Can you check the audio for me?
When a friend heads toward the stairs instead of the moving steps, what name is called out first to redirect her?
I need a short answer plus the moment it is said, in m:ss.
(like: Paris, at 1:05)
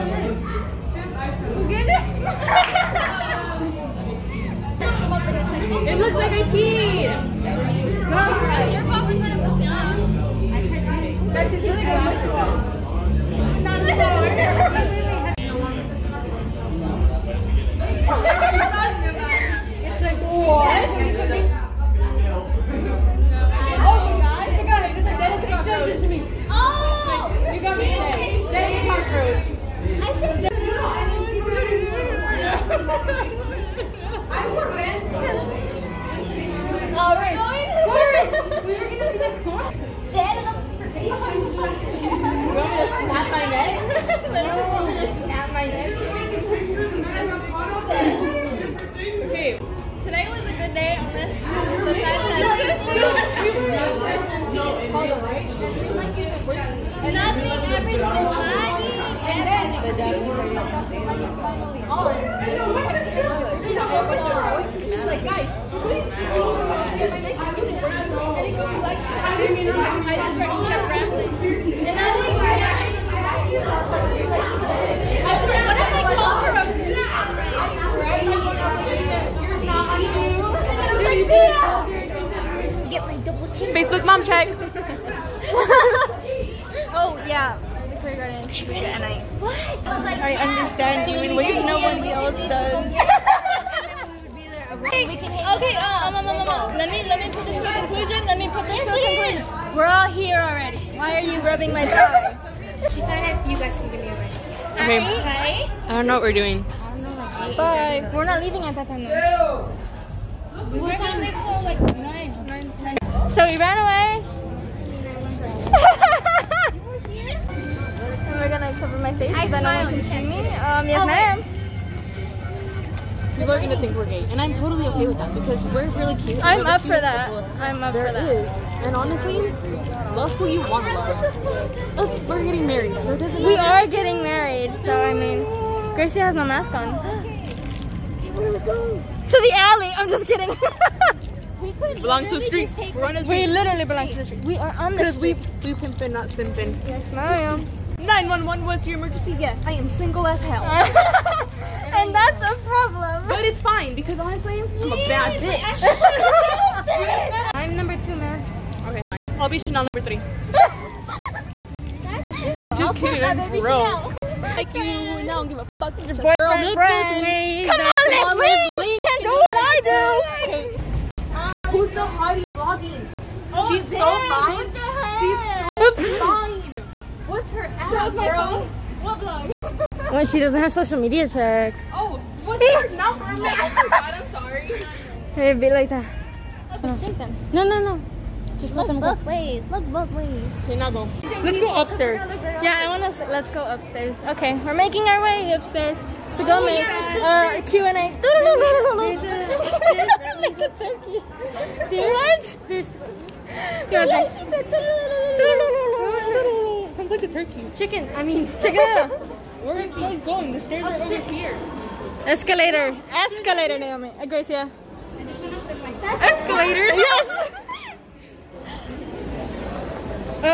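Naomi, at 3:33.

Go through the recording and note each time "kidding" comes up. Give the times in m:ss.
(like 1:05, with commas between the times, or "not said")
2:20, 2:42.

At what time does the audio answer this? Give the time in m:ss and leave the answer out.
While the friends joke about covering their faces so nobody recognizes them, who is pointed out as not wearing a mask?
2:15.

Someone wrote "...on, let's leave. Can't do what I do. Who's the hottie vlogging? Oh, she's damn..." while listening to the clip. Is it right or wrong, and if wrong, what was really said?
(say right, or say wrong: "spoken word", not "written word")
right.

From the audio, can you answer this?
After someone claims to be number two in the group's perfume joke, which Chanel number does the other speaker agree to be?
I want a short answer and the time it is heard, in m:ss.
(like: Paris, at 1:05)
3, at 2:39.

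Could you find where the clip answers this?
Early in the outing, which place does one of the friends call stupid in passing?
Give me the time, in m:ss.
1:27.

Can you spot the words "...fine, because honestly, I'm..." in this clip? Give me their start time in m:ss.
2:33.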